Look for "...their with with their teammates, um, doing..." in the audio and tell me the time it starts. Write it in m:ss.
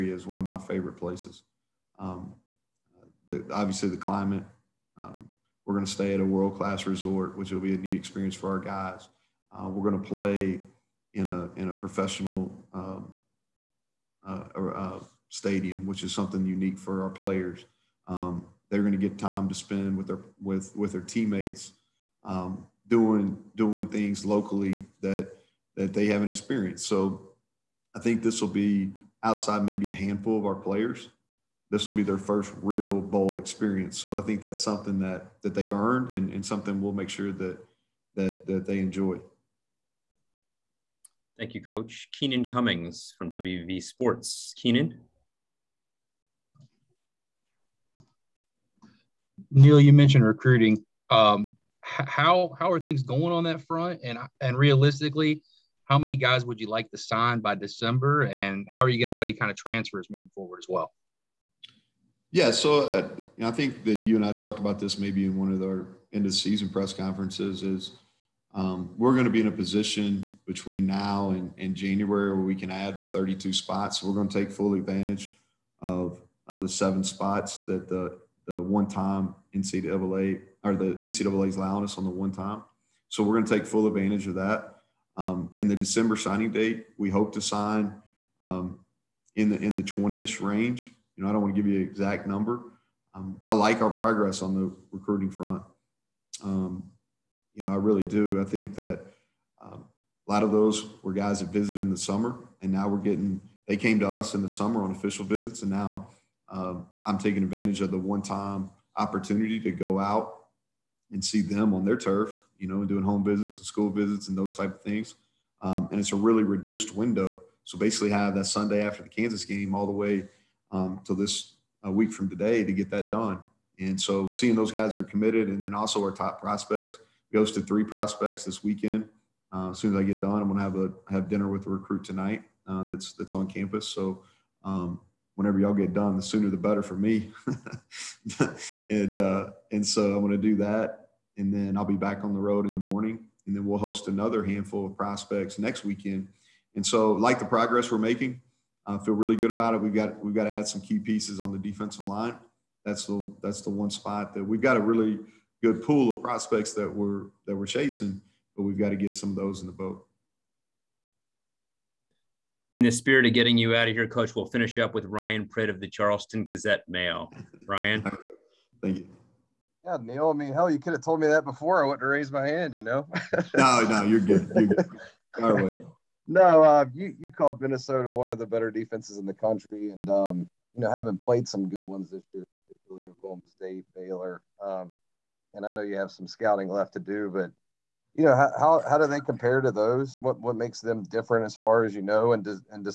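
0:20.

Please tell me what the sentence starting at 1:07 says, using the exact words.
Is um, we're going to be in a position between now and, and January where we can add the 32 spots.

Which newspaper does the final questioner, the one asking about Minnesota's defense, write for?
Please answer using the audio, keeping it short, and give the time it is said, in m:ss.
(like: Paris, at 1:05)
Charleston Gazette Mail, at 2:45.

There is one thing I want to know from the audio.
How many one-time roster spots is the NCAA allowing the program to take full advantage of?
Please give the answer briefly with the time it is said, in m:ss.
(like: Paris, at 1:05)
7, at 1:16.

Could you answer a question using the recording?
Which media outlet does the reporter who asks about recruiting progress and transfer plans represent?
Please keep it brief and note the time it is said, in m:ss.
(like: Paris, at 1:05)
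WV Sports, at 0:43.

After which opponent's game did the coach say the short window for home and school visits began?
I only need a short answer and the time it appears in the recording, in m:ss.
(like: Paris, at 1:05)
Kansas, at 1:59.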